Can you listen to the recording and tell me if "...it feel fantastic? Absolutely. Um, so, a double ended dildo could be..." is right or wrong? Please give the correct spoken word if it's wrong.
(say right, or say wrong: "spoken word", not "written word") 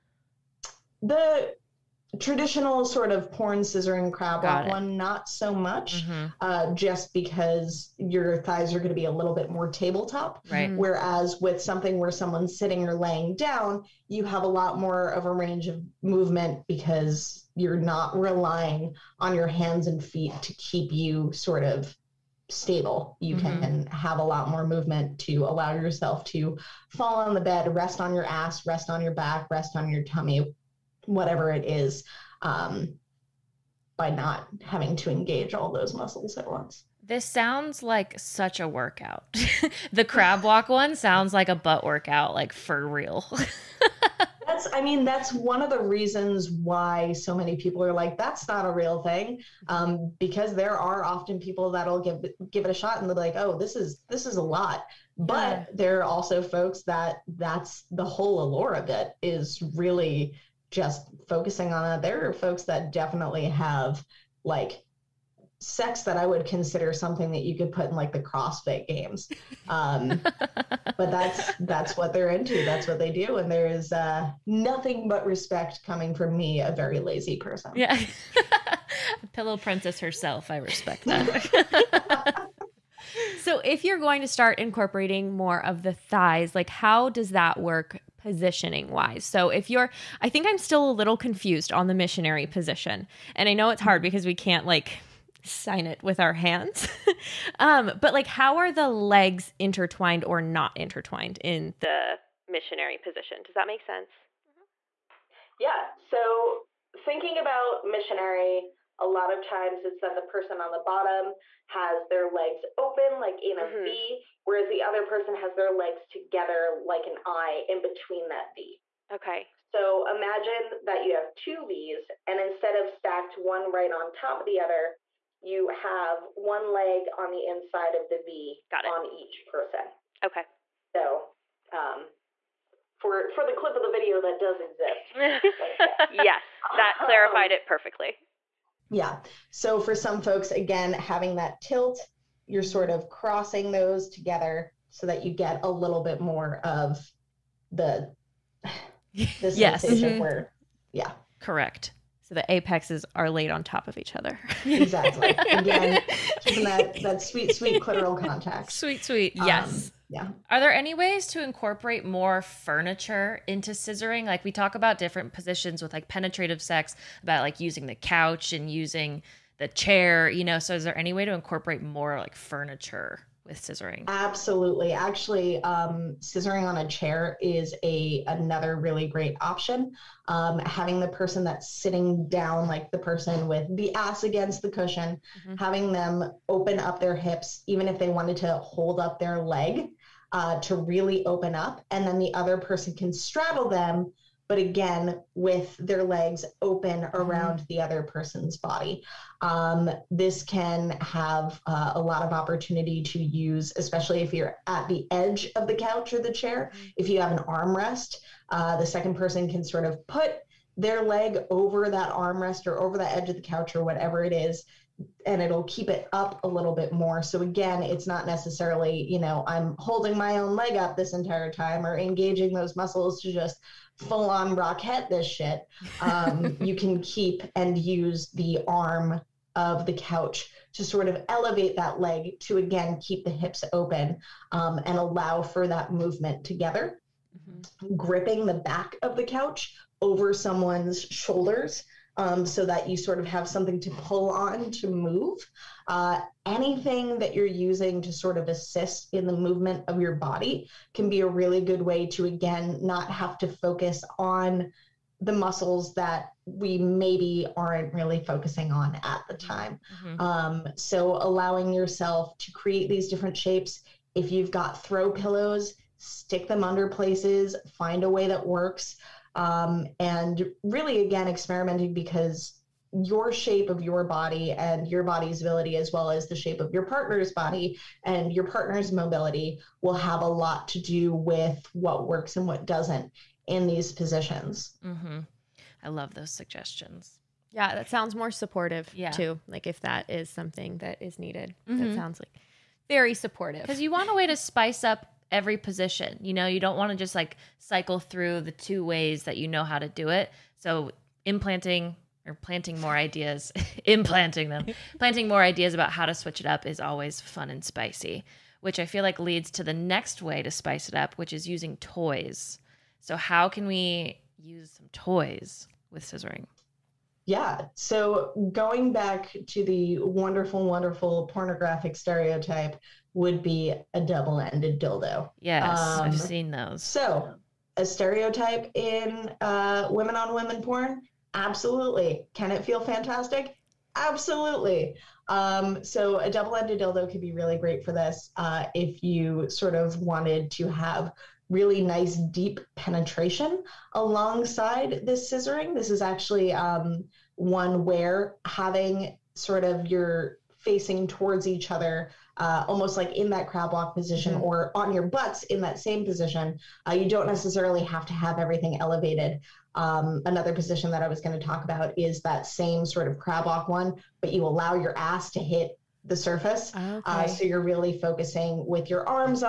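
right.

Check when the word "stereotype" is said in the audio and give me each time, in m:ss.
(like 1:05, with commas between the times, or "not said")
5:21, 5:27.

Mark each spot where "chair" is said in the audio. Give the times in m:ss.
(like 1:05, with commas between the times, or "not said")
2:49, 2:56, 3:26.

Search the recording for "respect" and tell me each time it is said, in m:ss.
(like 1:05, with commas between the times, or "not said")
1:15, 1:20.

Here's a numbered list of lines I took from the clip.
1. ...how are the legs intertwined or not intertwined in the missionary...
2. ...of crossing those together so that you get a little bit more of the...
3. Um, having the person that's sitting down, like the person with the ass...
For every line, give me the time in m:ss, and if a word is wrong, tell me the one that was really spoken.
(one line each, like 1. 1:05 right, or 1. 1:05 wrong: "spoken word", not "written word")
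1. 1:38 right
2. 2:22 right
3. 3:00 right.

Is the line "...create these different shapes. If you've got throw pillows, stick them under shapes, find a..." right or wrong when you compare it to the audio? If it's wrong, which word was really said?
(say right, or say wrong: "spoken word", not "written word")
wrong: "places", not "shapes".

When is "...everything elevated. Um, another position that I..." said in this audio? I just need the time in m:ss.
5:58.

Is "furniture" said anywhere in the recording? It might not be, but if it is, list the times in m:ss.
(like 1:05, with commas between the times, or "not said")
2:42, 2:52.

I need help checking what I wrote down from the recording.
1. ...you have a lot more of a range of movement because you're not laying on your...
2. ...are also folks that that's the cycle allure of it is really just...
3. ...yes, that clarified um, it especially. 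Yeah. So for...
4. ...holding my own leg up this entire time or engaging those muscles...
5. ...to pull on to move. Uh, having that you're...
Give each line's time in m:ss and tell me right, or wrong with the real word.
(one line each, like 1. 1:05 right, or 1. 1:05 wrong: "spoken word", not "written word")
1. 0:14 wrong: "relying", not "laying"
2. 0:55 wrong: "whole", not "cycle"
3. 2:16 wrong: "perfectly", not "especially"
4. 3:39 right
5. 4:03 wrong: "anything", not "having".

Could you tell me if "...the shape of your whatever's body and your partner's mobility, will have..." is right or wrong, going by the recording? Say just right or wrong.
wrong.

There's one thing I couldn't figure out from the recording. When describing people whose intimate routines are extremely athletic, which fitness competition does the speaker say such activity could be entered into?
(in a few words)
CrossFit Games.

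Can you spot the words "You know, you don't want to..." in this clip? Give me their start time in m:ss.
4:56.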